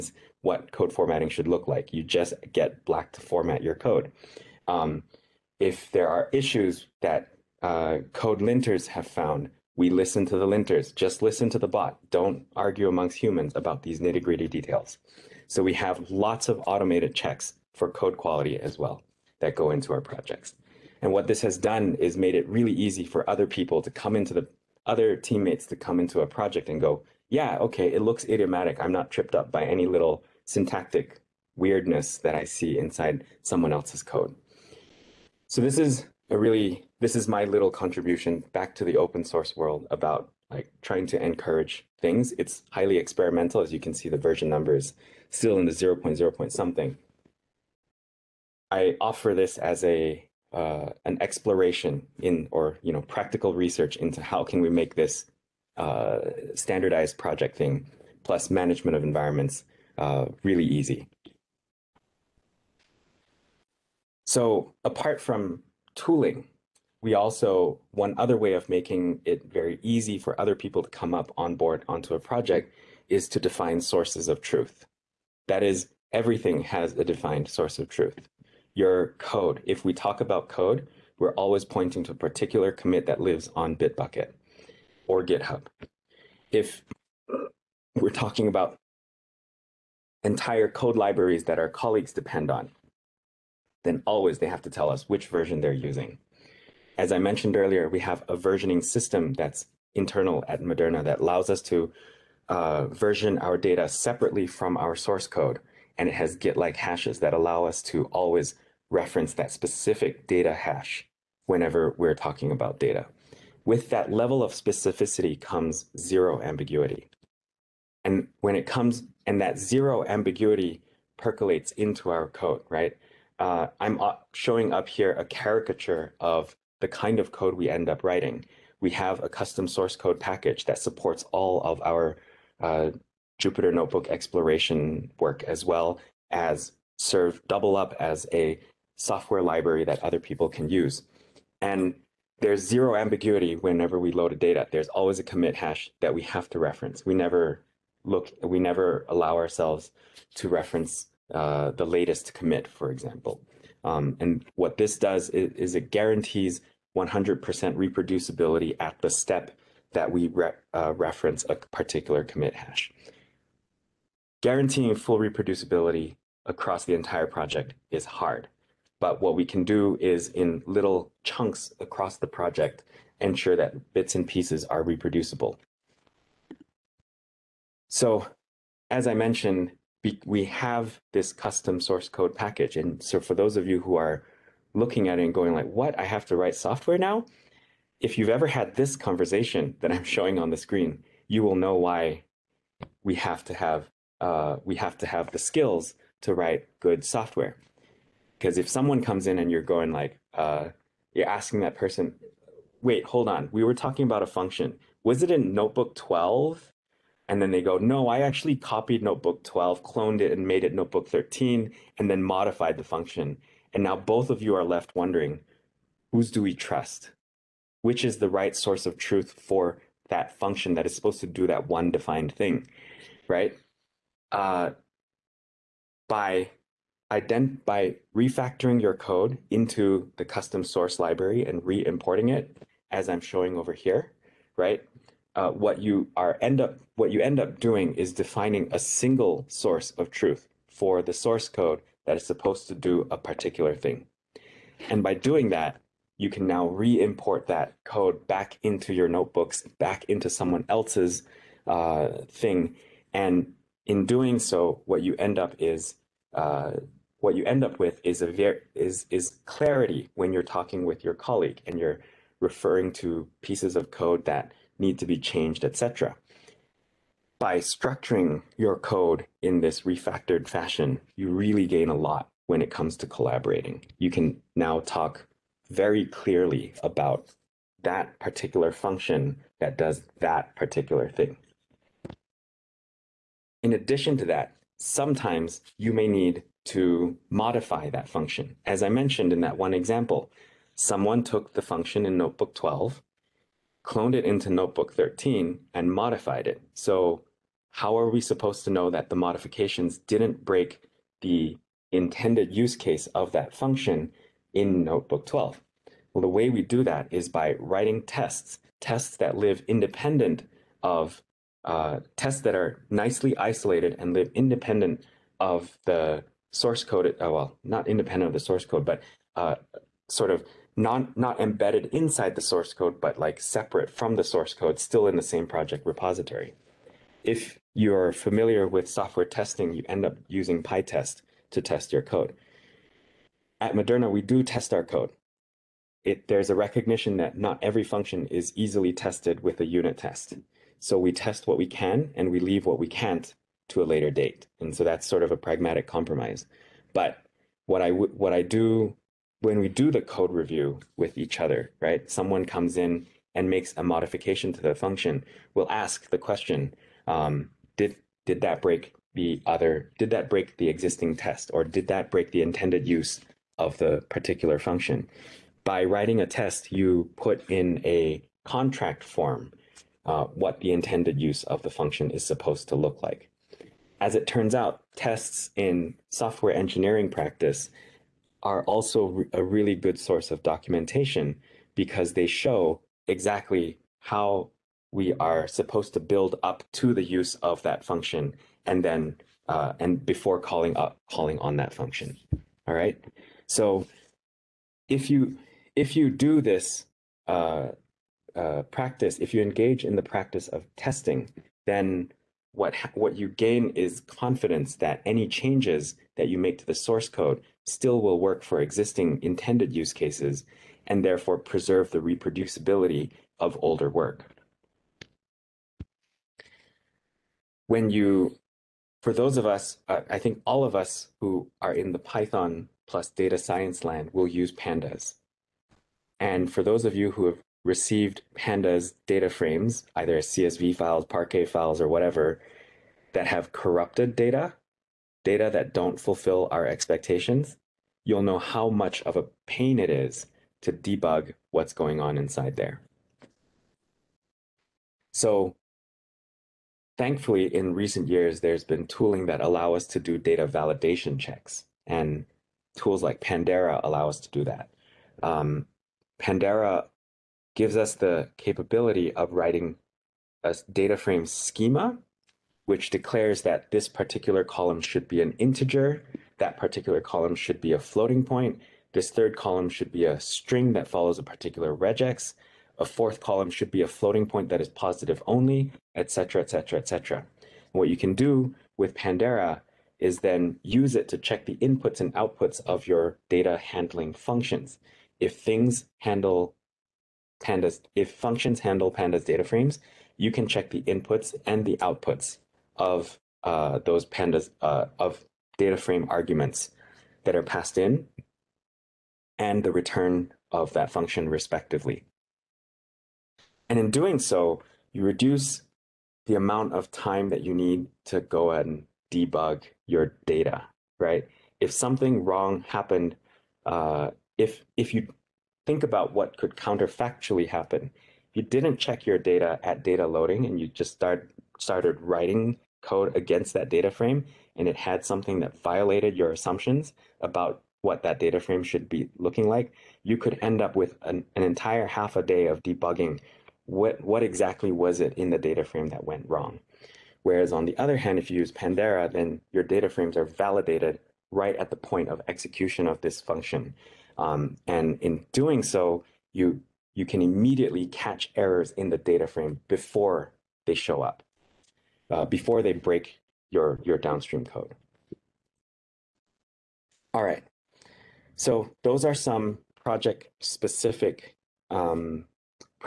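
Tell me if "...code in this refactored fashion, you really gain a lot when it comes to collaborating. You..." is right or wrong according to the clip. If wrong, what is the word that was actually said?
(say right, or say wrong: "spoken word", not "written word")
right.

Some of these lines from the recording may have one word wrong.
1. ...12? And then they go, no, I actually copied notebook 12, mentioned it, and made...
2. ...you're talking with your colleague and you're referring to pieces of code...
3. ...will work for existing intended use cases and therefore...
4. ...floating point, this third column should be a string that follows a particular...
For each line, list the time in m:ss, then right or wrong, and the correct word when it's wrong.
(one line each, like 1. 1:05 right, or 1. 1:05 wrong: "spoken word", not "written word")
1. 3:25 wrong: "cloned", not "mentioned"
2. 4:20 right
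3. 6:48 right
4. 7:47 right.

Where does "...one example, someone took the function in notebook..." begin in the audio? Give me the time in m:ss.
4:49.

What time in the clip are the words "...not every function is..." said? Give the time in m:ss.
5:37.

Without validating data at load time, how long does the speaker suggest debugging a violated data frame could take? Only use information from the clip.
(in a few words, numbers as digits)
Half a day.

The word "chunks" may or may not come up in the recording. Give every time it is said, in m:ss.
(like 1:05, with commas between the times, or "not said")
2:51.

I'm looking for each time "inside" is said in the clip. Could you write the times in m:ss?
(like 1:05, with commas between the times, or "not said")
0:32, 5:21, 7:22.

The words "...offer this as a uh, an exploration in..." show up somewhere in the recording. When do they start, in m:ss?
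0:49.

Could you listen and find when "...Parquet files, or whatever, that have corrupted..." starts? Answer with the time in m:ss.
7:11.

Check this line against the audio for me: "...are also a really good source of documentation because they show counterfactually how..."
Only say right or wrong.
wrong.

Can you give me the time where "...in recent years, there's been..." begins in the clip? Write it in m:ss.
7:27.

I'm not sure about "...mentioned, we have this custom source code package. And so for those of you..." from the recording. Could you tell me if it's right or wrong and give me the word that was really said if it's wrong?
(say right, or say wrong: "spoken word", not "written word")
right.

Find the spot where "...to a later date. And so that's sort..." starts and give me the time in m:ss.
5:43.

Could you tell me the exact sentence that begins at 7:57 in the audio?
What you can do with Pandera is then use it to check the inputs and outputs of your data handling functions.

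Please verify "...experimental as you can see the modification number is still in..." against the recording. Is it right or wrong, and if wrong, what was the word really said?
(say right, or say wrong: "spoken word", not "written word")
wrong: "version", not "modification".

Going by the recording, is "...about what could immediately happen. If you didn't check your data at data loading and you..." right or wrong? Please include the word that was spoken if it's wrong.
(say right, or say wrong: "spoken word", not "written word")
wrong: "counterfactually", not "immediately".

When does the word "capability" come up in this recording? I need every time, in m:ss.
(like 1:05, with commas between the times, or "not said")
7:38.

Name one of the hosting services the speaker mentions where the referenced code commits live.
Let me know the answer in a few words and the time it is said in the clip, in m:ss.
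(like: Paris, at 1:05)
Bitbucket, at 1:23.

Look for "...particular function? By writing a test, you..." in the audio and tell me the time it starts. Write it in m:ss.
6:04.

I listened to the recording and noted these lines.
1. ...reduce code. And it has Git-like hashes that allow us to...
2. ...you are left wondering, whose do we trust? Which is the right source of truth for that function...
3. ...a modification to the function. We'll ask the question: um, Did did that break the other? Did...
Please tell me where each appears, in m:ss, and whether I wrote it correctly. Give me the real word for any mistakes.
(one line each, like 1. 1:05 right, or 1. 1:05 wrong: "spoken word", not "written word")
1. 1:44 wrong: "source", not "reduce"
2. 3:34 right
3. 5:53 right.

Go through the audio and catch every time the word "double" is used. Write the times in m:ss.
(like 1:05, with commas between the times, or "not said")
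2:17.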